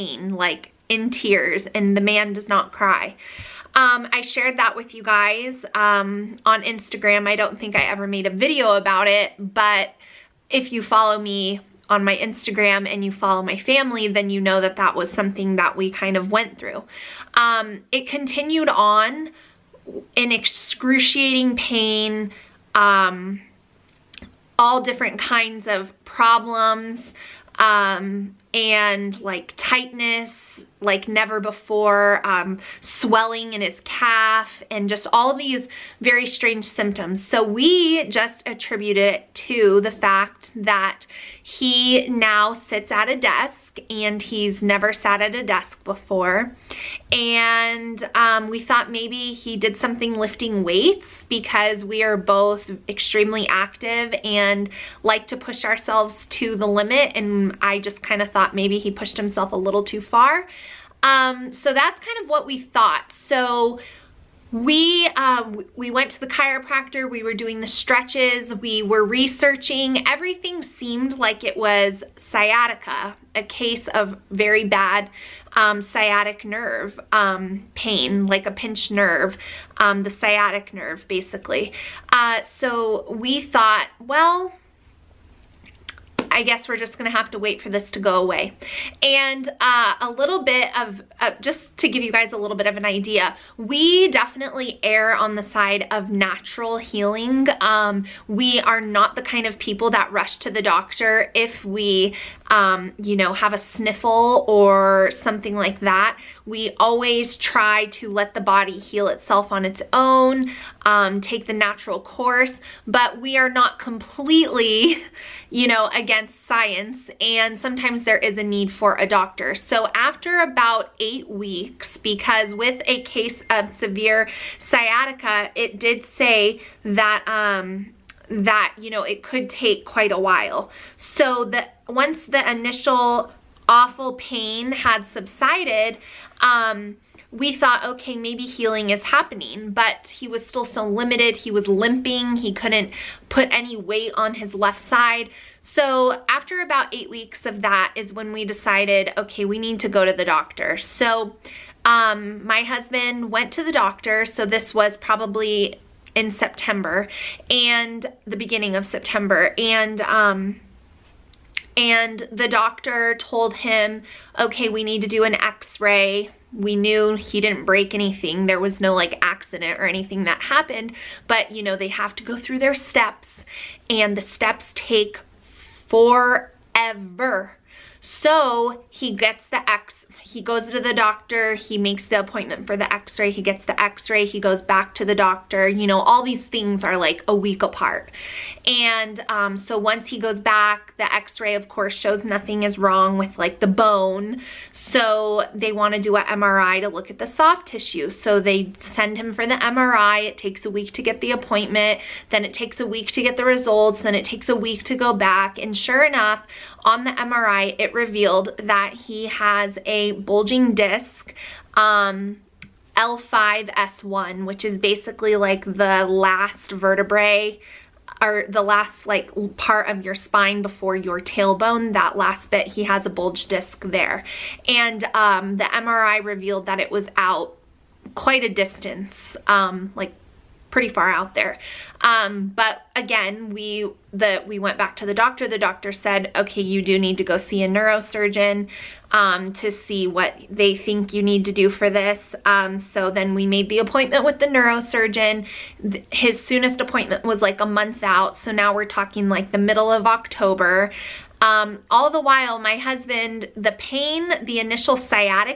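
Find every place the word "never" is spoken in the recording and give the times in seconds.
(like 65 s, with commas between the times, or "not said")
31 s, 44 s.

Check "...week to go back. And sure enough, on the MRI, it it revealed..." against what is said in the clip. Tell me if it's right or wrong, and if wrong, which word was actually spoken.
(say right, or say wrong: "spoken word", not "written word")
right.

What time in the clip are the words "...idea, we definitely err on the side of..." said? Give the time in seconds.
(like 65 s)
92 s.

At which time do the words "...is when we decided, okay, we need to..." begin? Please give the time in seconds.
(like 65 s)
147 s.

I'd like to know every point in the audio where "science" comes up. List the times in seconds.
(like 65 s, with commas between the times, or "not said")
116 s.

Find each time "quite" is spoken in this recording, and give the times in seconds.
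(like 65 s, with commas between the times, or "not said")
129 s, 228 s.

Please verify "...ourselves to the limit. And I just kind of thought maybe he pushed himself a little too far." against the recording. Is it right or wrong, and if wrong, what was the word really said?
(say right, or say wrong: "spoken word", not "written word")
right.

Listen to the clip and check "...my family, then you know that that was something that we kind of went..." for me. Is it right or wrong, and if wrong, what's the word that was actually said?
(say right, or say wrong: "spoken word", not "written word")
right.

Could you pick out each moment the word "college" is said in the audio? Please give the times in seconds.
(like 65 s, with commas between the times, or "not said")
not said.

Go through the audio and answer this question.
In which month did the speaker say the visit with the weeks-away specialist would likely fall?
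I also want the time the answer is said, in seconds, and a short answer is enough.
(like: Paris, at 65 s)
October, at 250 s.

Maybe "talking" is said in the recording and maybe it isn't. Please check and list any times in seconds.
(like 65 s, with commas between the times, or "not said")
248 s.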